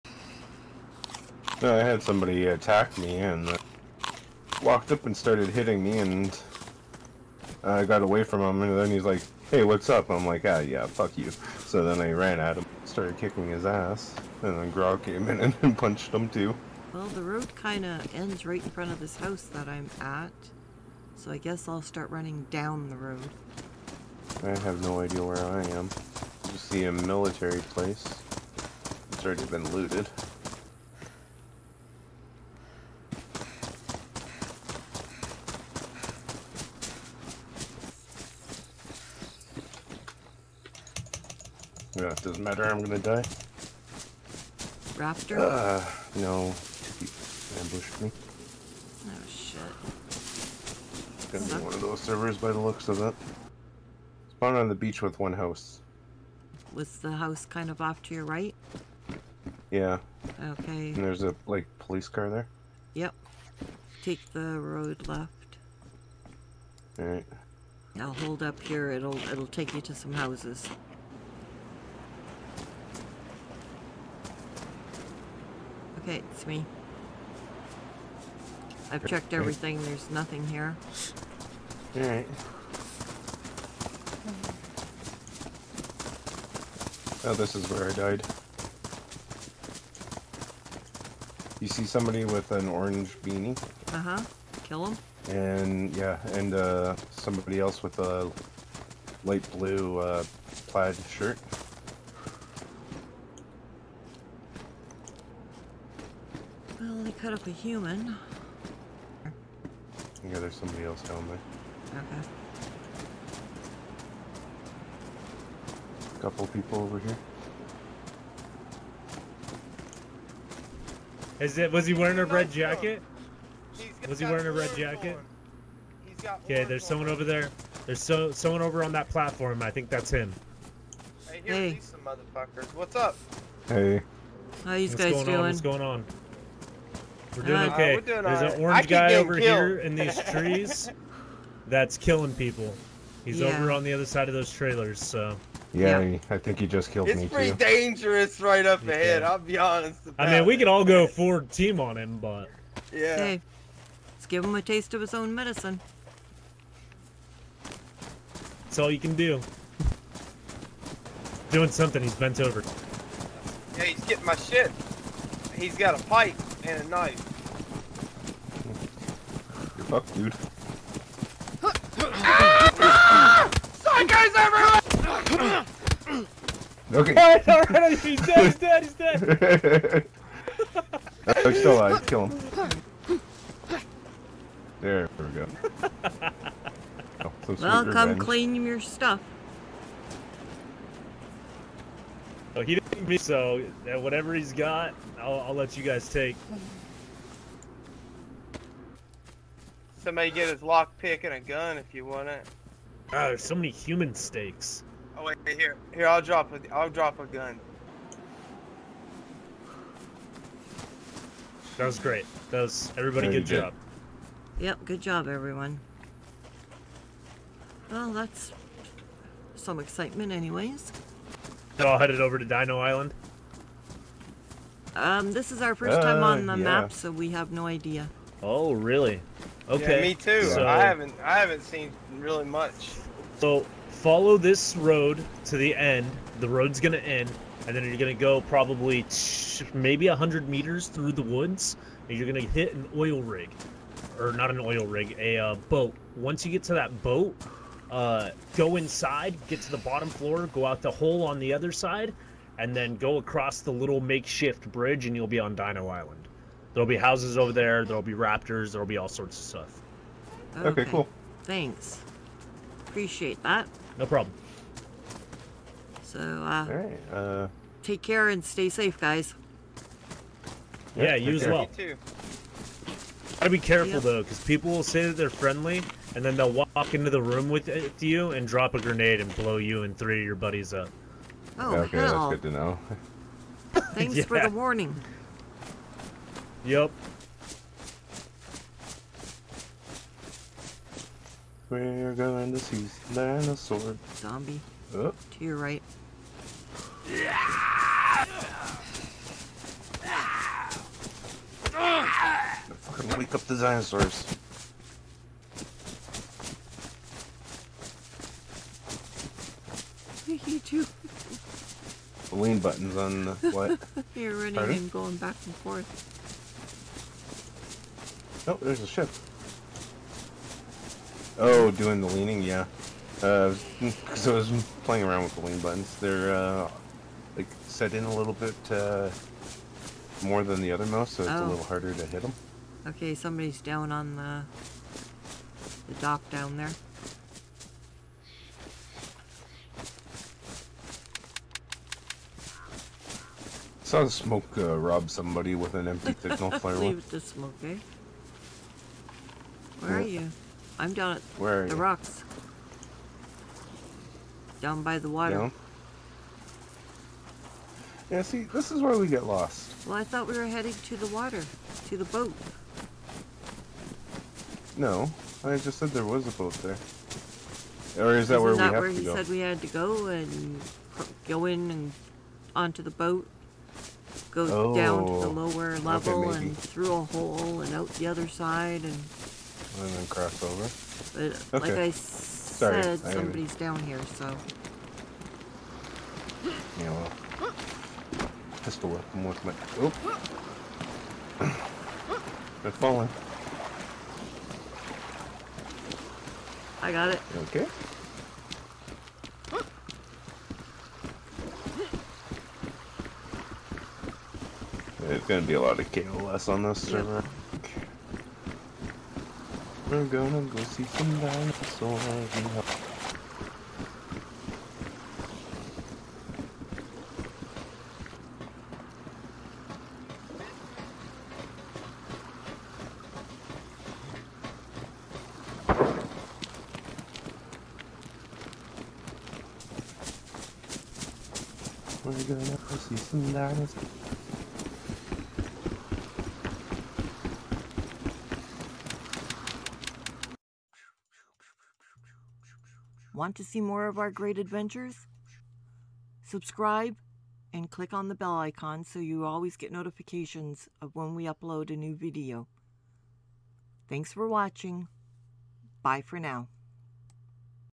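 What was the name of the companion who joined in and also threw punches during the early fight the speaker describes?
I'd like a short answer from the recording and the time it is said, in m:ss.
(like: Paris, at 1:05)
Grog, at 0:14.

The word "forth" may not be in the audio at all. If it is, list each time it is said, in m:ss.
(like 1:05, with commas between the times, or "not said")
5:15.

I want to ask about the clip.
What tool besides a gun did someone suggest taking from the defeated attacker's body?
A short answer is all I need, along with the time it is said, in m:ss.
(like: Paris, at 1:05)
lockpick, at 3:20.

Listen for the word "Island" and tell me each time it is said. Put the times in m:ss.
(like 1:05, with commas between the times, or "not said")
3:42, 4:15.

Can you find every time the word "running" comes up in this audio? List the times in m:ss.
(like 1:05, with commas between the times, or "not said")
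0:22, 5:14.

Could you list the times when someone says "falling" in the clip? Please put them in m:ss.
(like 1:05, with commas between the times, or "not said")
6:32.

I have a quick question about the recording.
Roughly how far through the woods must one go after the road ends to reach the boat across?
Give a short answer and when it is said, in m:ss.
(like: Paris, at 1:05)
100 meters, at 4:00.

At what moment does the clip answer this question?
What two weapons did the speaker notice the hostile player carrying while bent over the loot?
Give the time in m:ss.
2:45.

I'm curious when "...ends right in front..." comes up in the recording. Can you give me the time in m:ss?
0:18.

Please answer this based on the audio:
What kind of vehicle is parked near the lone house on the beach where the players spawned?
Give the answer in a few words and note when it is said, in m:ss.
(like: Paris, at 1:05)
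police car, at 1:01.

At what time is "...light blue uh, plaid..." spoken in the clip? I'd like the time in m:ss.
1:39.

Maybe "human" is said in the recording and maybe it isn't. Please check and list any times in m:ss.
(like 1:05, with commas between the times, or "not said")
1:47, 3:23.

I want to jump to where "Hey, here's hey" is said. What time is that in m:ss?
2:11.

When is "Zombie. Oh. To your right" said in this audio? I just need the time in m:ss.
4:54.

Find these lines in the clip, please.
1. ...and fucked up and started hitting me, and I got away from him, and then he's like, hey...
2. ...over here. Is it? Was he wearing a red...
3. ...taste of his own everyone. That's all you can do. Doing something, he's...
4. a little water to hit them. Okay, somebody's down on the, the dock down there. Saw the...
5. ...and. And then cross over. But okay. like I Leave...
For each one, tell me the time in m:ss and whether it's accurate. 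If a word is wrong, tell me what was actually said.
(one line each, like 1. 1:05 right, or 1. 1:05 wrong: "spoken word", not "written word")
1. 0:03 wrong: "walked", not "fucked"
2. 1:56 right
3. 2:34 wrong: "medicine", not "everyone"
4. 5:31 wrong: "harder", not "water"
5. 6:18 wrong: "Sorry", not "Leave".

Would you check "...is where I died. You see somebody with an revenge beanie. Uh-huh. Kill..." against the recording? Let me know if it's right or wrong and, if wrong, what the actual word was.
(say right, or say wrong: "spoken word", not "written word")
wrong: "orange", not "revenge".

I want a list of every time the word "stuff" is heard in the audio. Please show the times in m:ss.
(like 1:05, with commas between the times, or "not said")
3:08, 4:19.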